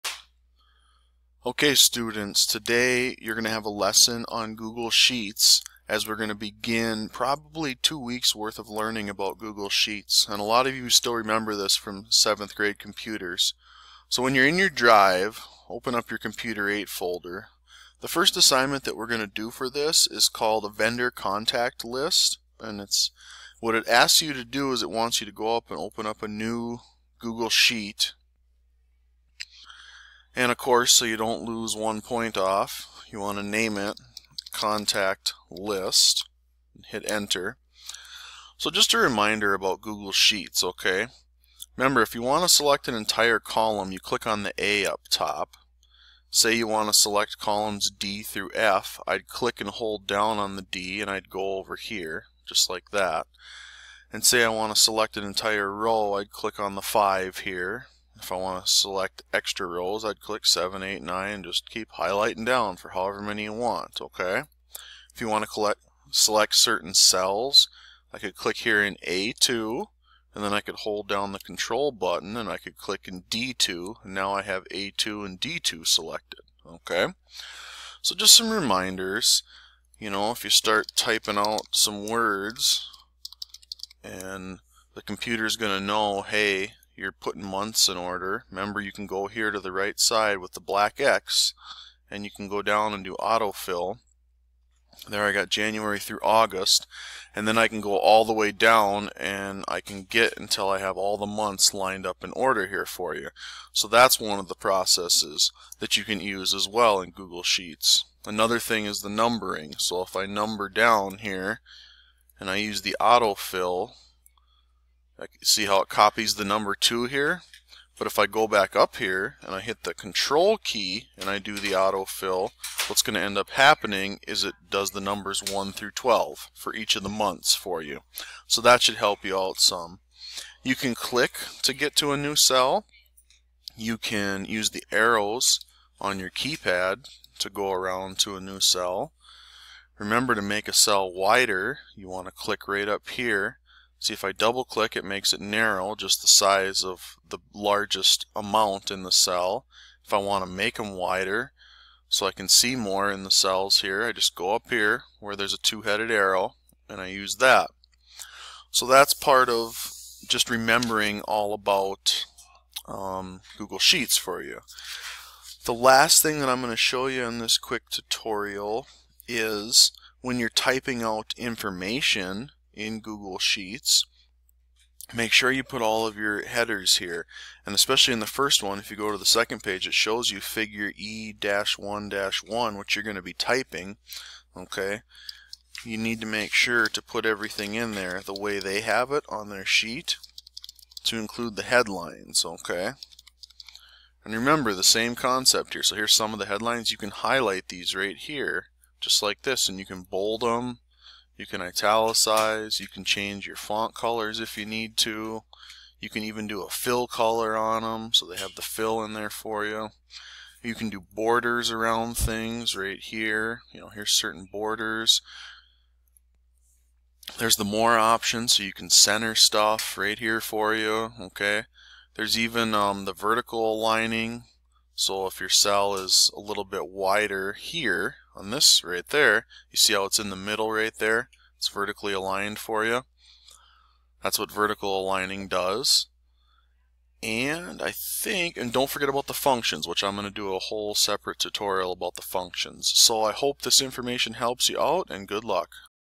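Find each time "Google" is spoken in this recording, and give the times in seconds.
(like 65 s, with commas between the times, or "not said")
4 s, 9 s, 27 s, 39 s, 107 s, 163 s, 172 s.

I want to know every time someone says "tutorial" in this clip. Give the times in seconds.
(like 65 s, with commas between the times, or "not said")
167 s, 241 s.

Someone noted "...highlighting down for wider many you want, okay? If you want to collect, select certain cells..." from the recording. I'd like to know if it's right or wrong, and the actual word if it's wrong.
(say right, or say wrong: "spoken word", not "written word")
wrong: "however", not "wider".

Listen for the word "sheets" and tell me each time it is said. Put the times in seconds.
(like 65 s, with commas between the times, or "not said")
4 s, 9 s, 27 s, 40 s, 107 s, 163 s, 173 s, 189 s.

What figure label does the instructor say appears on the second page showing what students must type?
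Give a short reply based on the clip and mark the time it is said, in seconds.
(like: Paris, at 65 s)
E-1-1, at 180 s.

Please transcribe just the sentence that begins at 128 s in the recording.
So that should help you out some.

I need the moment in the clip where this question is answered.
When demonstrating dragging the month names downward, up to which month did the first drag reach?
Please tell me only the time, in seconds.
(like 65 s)
96 s.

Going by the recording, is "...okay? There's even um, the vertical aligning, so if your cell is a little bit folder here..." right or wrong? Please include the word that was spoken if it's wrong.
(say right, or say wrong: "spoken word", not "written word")
wrong: "wider", not "folder".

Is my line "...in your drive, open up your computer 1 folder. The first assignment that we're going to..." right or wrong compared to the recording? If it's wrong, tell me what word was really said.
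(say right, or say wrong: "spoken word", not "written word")
wrong: "8", not "1".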